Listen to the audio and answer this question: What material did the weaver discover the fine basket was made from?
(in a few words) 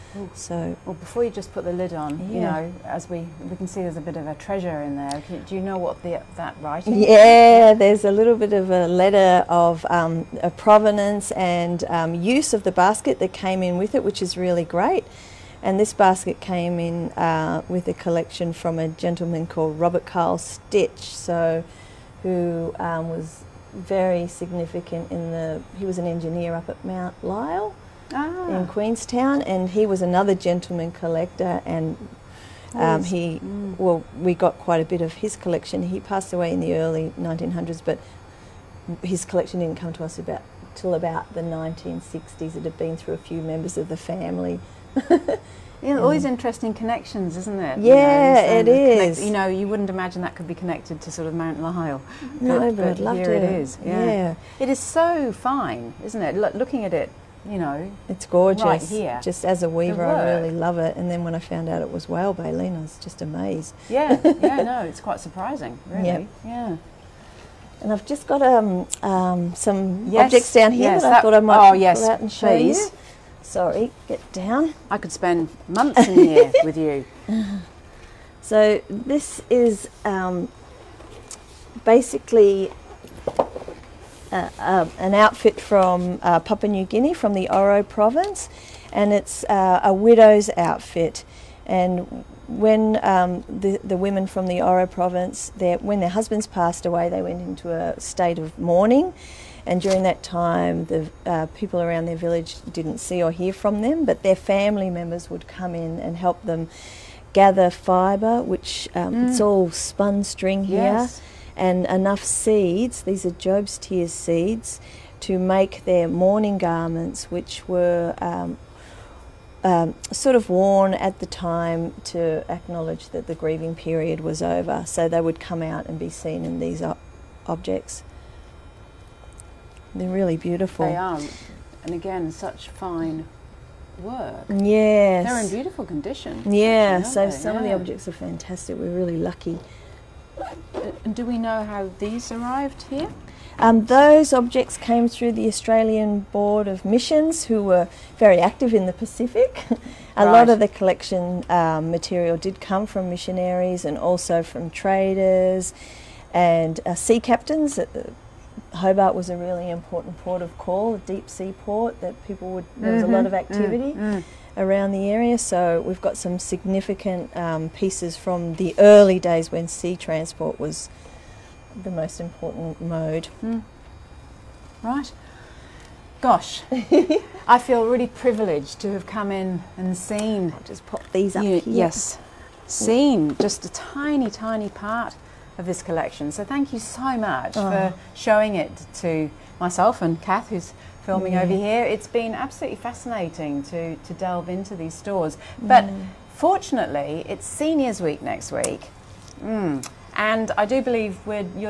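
Whale baleen.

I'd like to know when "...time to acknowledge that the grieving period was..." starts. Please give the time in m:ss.
2:01.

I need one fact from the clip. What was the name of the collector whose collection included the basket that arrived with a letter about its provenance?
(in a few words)
Robert Carl Sticht.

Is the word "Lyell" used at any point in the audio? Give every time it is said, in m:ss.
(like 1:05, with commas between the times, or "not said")
0:27, 0:51.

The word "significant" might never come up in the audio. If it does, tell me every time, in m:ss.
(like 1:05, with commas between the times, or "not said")
0:24, 2:46.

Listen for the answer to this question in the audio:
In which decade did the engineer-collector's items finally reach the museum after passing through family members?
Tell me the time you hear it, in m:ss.
0:41.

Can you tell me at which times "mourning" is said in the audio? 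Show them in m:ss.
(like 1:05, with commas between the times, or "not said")
1:38, 1:56.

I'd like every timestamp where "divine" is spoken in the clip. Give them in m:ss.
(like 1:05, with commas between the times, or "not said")
not said.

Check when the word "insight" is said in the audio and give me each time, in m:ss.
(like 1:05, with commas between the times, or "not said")
not said.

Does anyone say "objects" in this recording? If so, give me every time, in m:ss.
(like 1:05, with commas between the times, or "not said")
1:10, 2:07, 2:17, 2:24.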